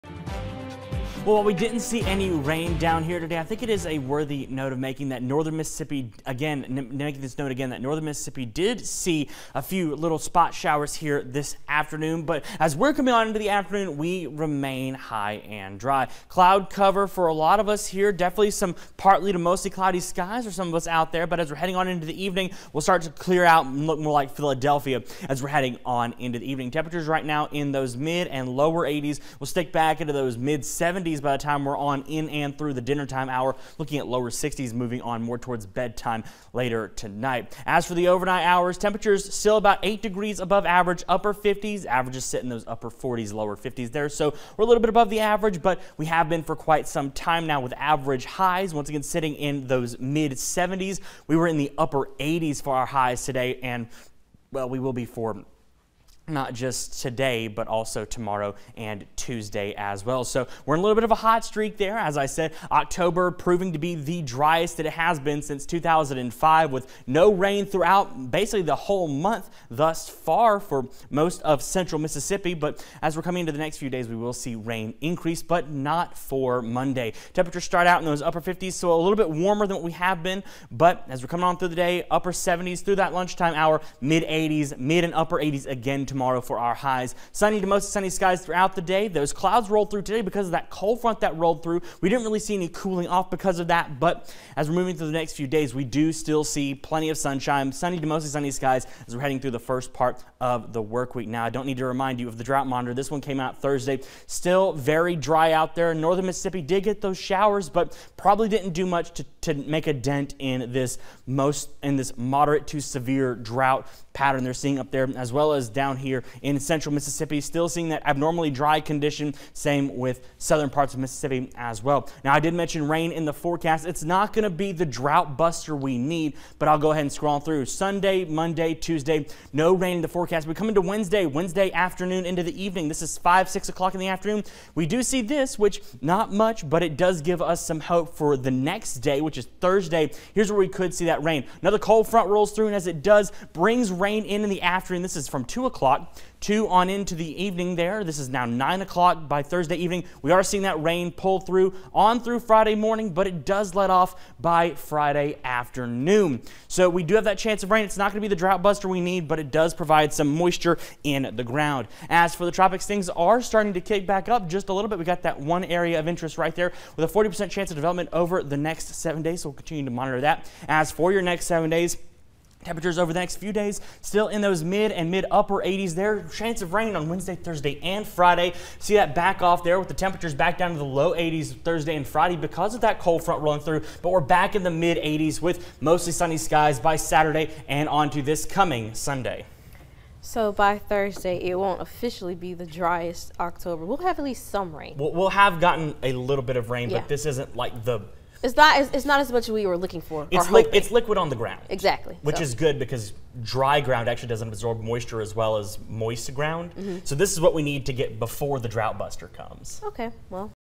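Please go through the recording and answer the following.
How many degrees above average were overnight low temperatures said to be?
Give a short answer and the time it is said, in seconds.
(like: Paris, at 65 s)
8 degrees, at 39 s.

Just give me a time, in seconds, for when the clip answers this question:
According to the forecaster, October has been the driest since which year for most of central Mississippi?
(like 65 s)
65 s.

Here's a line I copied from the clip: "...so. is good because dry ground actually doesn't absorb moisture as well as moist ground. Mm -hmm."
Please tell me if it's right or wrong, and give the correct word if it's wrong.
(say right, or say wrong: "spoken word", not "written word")
right.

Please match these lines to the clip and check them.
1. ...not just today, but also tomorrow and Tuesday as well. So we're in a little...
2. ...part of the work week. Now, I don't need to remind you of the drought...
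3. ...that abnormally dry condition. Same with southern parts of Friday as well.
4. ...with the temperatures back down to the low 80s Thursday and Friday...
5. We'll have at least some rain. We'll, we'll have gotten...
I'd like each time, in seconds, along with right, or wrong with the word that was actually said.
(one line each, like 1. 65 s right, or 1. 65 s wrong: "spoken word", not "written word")
1. 56 s right
2. 99 s right
3. 117 s wrong: "Mississippi", not "Friday"
4. 179 s right
5. 193 s right.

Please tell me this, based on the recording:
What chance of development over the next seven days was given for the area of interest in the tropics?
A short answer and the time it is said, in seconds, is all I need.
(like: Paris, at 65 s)
40%, at 167 s.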